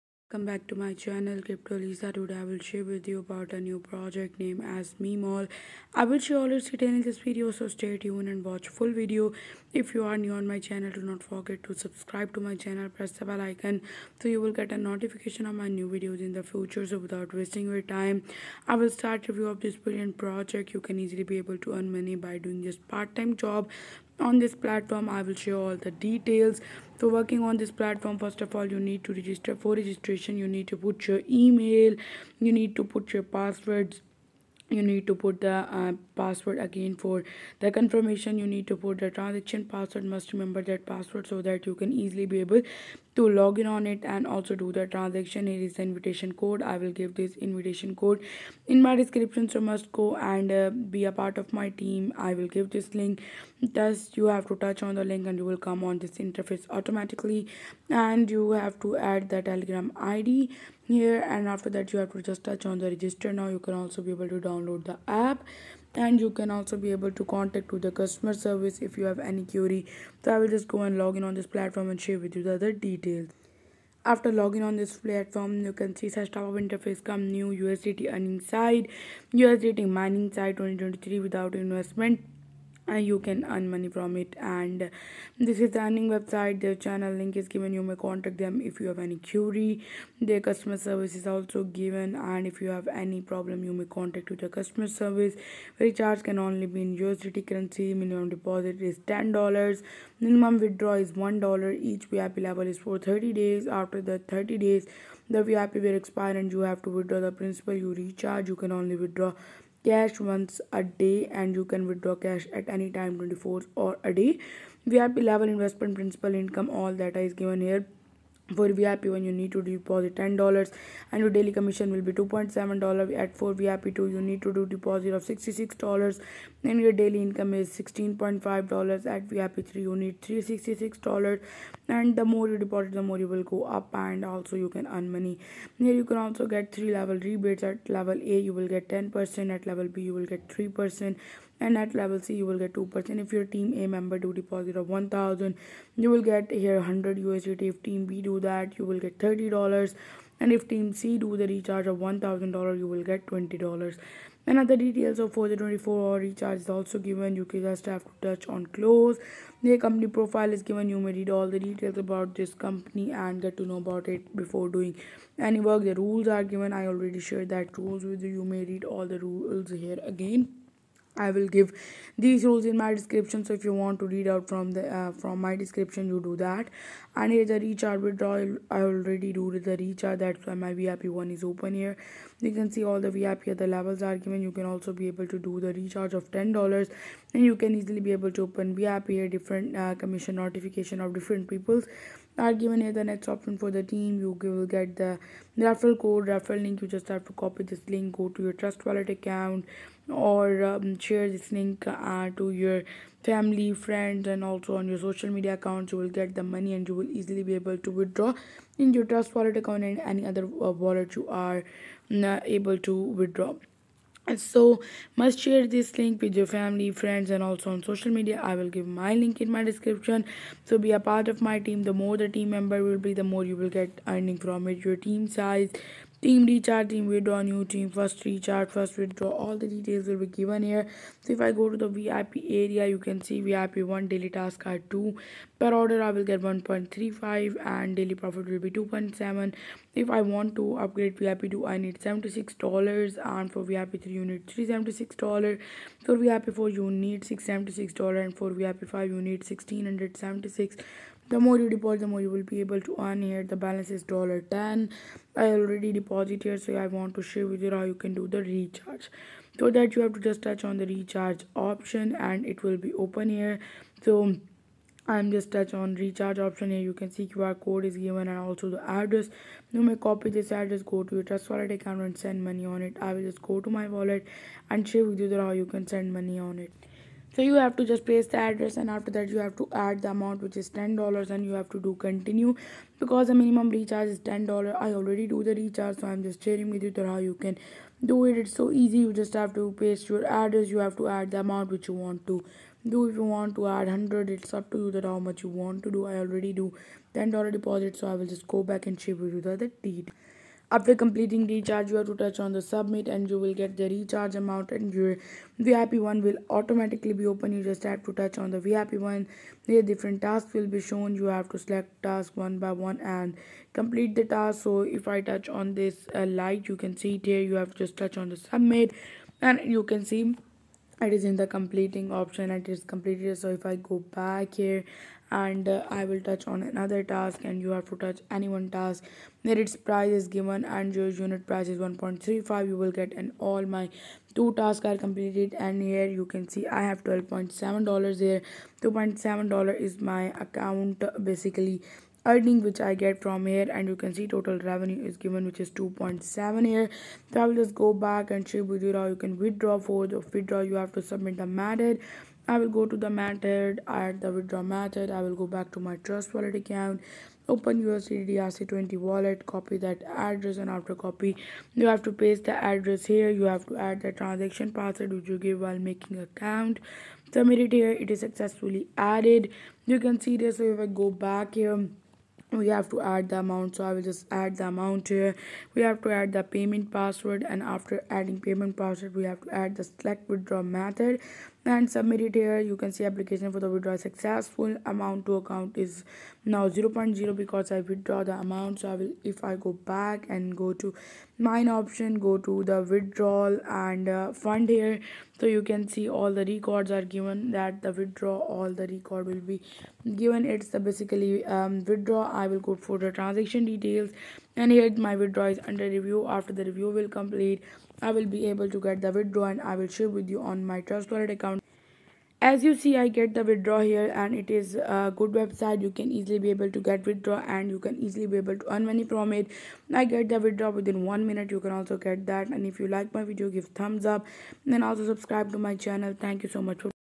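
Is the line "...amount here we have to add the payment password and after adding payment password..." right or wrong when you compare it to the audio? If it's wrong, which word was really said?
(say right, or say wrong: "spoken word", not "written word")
right.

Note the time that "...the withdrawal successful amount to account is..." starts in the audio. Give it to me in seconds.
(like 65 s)
383 s.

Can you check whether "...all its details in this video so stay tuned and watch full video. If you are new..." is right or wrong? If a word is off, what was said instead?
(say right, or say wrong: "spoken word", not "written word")
right.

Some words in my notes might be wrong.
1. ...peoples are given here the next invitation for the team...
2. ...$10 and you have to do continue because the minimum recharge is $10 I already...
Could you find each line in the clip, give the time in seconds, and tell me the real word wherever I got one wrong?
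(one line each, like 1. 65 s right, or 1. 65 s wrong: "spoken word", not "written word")
1. 191 s wrong: "option", not "invitation"
2. 280 s right.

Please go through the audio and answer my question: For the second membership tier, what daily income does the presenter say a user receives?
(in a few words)
$16.5.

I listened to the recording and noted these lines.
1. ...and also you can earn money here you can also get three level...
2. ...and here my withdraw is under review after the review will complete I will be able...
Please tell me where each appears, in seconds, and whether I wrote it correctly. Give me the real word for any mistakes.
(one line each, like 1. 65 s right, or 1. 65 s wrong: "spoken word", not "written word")
1. 133 s right
2. 404 s right.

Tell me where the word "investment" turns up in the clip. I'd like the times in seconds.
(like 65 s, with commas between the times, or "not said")
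81 s, 115 s.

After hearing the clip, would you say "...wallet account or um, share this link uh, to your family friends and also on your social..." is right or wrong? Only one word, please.
right.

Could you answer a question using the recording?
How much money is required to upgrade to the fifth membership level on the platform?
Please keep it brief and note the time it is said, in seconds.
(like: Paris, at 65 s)
$1676, at 249 s.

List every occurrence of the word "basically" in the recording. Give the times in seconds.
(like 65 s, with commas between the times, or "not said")
341 s, 400 s.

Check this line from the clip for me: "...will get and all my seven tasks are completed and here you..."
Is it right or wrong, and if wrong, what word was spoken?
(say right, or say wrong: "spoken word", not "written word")
wrong: "two", not "seven".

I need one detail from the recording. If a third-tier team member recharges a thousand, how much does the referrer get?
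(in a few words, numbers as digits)
$20.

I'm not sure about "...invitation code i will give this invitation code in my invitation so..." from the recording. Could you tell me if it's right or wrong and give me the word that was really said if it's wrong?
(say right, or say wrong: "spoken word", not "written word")
wrong: "description", not "invitation".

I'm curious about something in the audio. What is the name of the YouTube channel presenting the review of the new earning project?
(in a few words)
Crypto Alisa.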